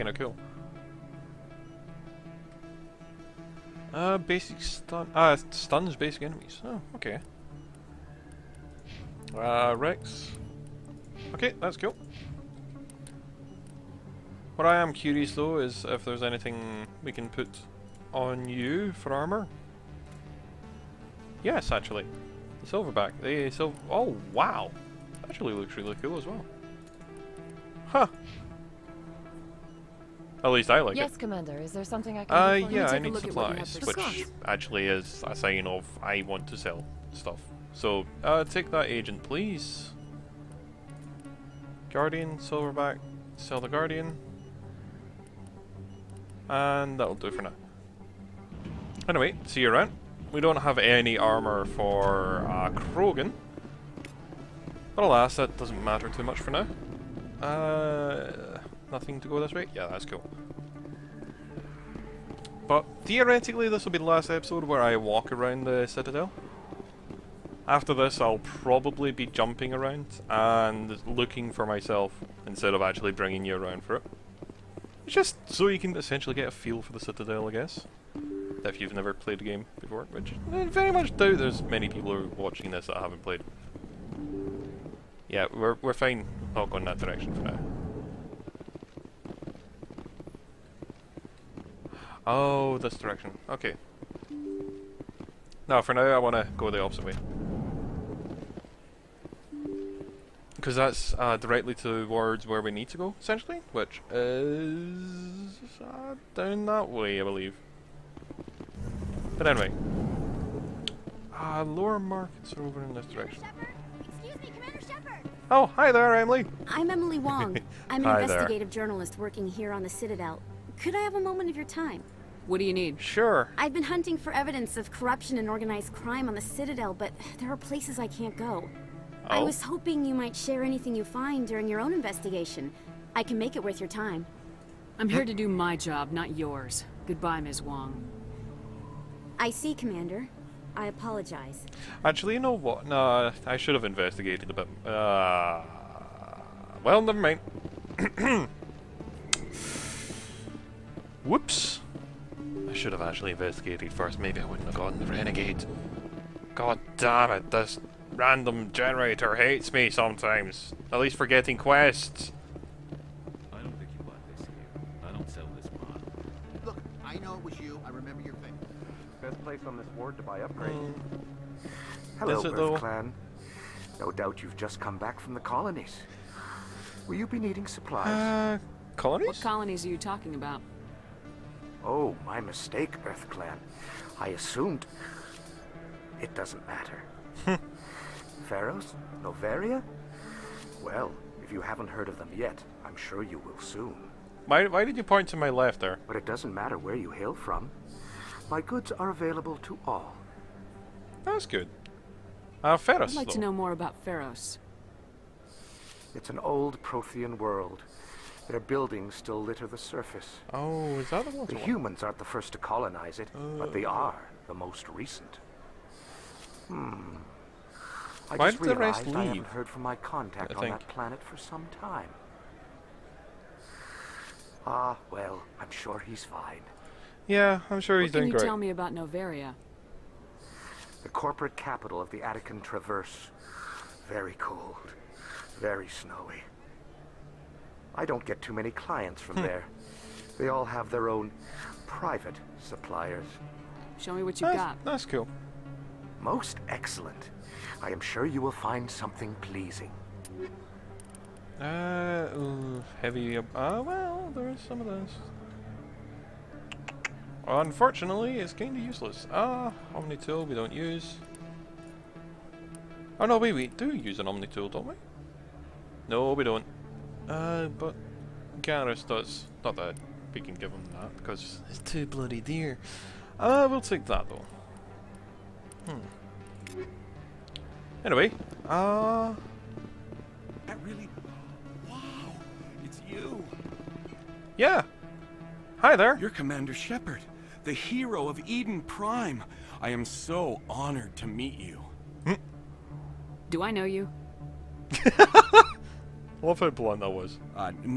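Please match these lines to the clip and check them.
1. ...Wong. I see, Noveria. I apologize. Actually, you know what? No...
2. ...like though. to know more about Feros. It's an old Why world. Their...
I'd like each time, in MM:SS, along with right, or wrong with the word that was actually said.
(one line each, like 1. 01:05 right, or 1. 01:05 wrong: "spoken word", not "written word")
1. 02:17 wrong: "Commander", not "Noveria"
2. 03:23 wrong: "Prothean", not "Why".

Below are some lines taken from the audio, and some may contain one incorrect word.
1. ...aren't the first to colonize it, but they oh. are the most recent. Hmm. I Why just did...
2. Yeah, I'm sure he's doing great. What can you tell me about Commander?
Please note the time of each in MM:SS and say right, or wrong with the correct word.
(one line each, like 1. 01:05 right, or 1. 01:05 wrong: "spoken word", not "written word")
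1. 03:32 right
2. 03:47 wrong: "Noveria", not "Commander".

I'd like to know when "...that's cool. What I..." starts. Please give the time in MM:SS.
00:11.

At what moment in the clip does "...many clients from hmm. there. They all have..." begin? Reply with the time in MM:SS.
03:58.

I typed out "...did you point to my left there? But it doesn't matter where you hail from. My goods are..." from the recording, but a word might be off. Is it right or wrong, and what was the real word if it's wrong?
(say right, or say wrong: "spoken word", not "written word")
right.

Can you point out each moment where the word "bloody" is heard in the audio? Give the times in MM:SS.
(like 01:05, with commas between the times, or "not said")
04:32.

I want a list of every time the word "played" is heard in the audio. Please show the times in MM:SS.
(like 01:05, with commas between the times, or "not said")
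01:19, 01:23.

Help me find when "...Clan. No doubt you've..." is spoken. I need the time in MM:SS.
02:52.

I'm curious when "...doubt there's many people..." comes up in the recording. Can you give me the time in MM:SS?
01:21.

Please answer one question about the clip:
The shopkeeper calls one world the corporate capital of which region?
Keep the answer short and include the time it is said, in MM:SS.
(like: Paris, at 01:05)
Attican Traverse, at 03:52.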